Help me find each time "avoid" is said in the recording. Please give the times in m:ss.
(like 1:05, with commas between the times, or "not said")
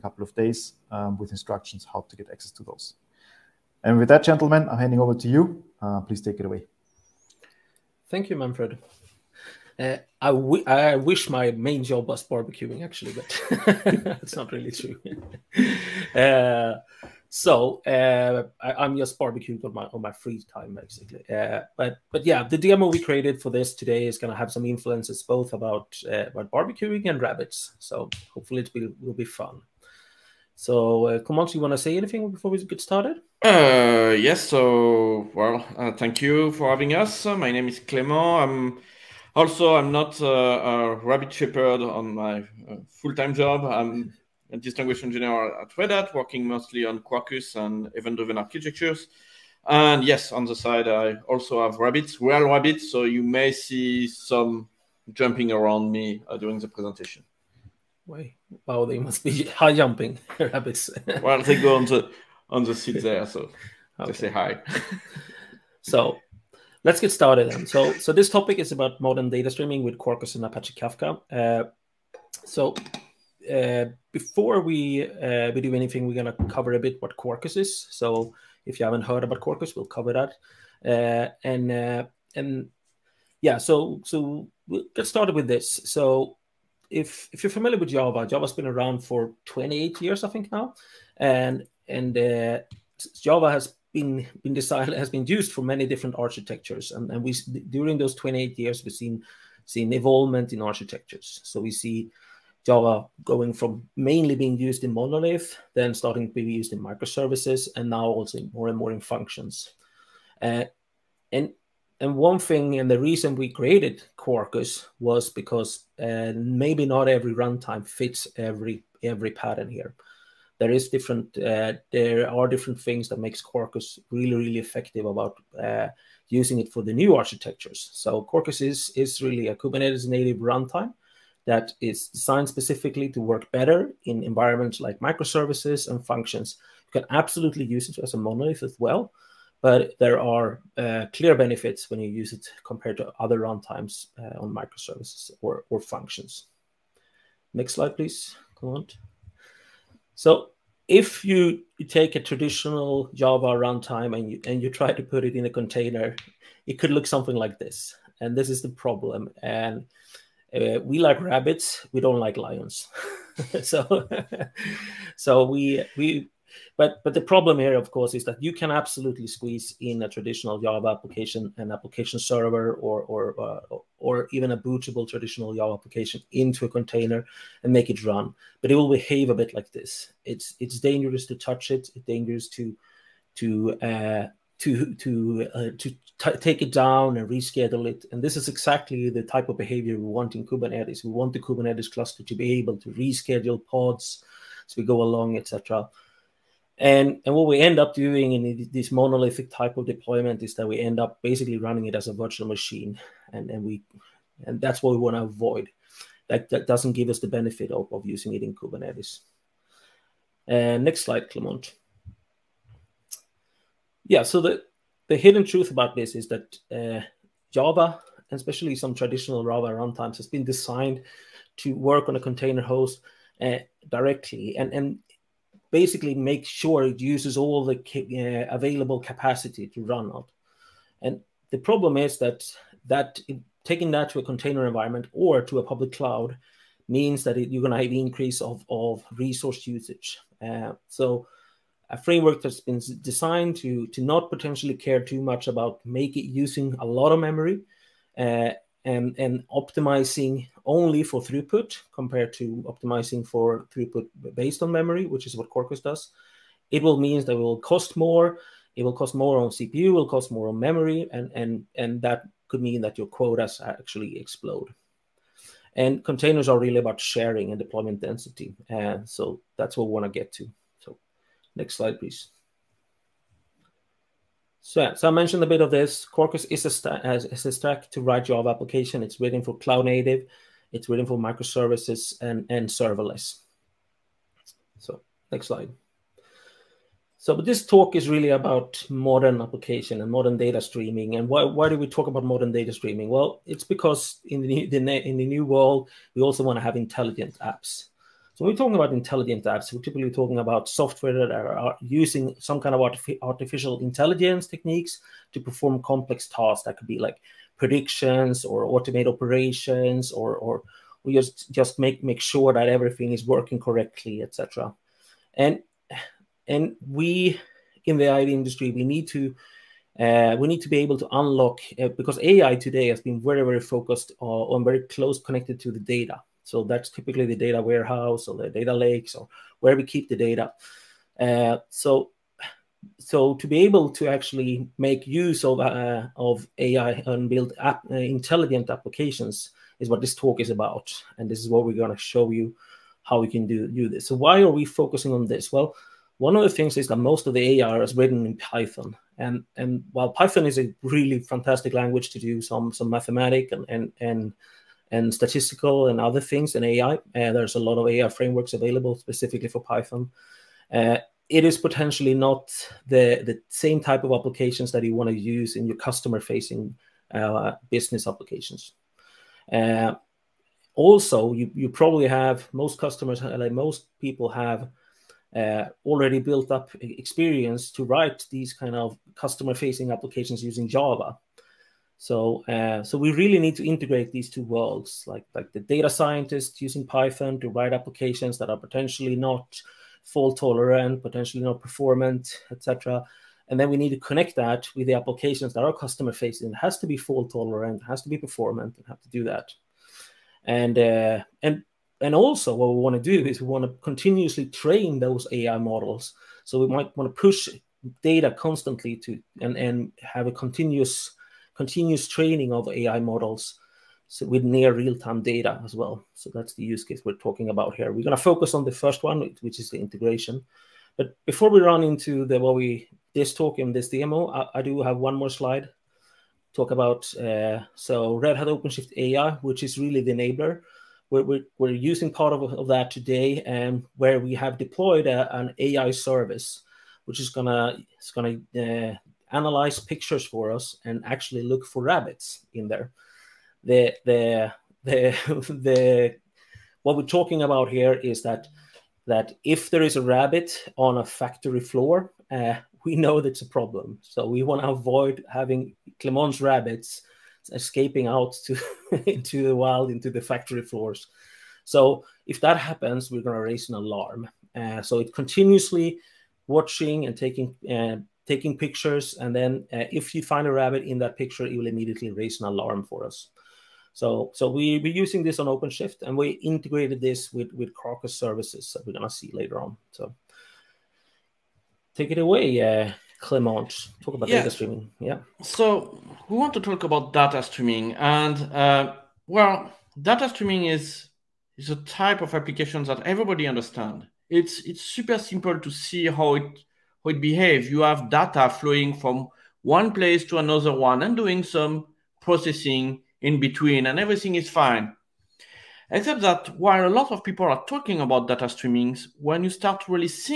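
3:25, 7:34.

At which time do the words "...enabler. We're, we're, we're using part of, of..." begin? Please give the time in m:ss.
7:10.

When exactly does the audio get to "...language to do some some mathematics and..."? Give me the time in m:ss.
5:51.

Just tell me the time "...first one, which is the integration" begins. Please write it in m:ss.
6:58.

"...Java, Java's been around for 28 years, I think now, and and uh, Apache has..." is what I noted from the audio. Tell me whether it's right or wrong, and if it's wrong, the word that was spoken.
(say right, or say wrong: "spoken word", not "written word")
wrong: "Java", not "Apache".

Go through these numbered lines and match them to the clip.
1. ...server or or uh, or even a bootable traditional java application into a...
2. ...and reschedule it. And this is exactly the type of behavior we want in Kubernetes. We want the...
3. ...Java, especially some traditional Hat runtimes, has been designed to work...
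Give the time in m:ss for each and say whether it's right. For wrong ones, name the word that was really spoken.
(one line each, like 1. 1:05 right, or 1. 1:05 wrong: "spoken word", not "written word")
1. 2:52 right
2. 3:07 right
3. 3:37 wrong: "Java", not "Hat".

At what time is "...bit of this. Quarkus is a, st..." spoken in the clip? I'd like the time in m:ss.
4:35.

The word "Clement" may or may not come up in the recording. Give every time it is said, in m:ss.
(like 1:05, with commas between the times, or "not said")
3:31, 7:35, 8:03.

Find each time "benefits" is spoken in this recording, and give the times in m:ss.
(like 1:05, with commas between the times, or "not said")
2:21, 3:27.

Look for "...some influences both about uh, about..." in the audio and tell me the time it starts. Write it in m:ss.
0:24.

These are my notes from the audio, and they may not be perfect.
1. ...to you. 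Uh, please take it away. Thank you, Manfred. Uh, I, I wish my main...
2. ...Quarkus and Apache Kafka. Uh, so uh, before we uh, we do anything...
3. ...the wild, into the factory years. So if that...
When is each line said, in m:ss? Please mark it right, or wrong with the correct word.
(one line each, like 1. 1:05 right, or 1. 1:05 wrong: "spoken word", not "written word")
1. 0:05 right
2. 1:09 right
3. 7:39 wrong: "floors", not "years".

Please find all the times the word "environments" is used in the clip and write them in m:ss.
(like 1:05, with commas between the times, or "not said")
2:14, 3:54.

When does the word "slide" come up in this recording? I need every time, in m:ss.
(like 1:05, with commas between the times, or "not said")
2:27, 3:31, 4:31, 4:45, 7:05.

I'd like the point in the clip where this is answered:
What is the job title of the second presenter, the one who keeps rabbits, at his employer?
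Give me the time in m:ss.
0:44.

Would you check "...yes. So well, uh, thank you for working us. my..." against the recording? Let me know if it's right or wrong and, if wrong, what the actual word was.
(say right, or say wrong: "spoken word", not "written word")
wrong: "having", not "working".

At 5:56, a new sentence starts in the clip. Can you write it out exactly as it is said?
Uh, there's a lot of AI frameworks available specifically for Python.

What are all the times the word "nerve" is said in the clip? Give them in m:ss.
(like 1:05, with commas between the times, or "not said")
not said.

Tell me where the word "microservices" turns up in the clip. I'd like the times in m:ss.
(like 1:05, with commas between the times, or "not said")
1:46, 2:14, 2:24, 4:41.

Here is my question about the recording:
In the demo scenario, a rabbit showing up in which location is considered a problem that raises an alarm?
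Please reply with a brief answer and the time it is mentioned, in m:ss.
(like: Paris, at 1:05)
Factory floor, at 7:31.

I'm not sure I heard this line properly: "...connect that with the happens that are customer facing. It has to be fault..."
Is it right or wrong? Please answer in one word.
wrong.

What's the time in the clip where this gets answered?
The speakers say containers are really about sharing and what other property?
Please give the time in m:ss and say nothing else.
4:27.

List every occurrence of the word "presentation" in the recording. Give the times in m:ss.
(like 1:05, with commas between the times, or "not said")
0:56.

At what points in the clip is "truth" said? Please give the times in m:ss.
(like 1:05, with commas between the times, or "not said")
3:35.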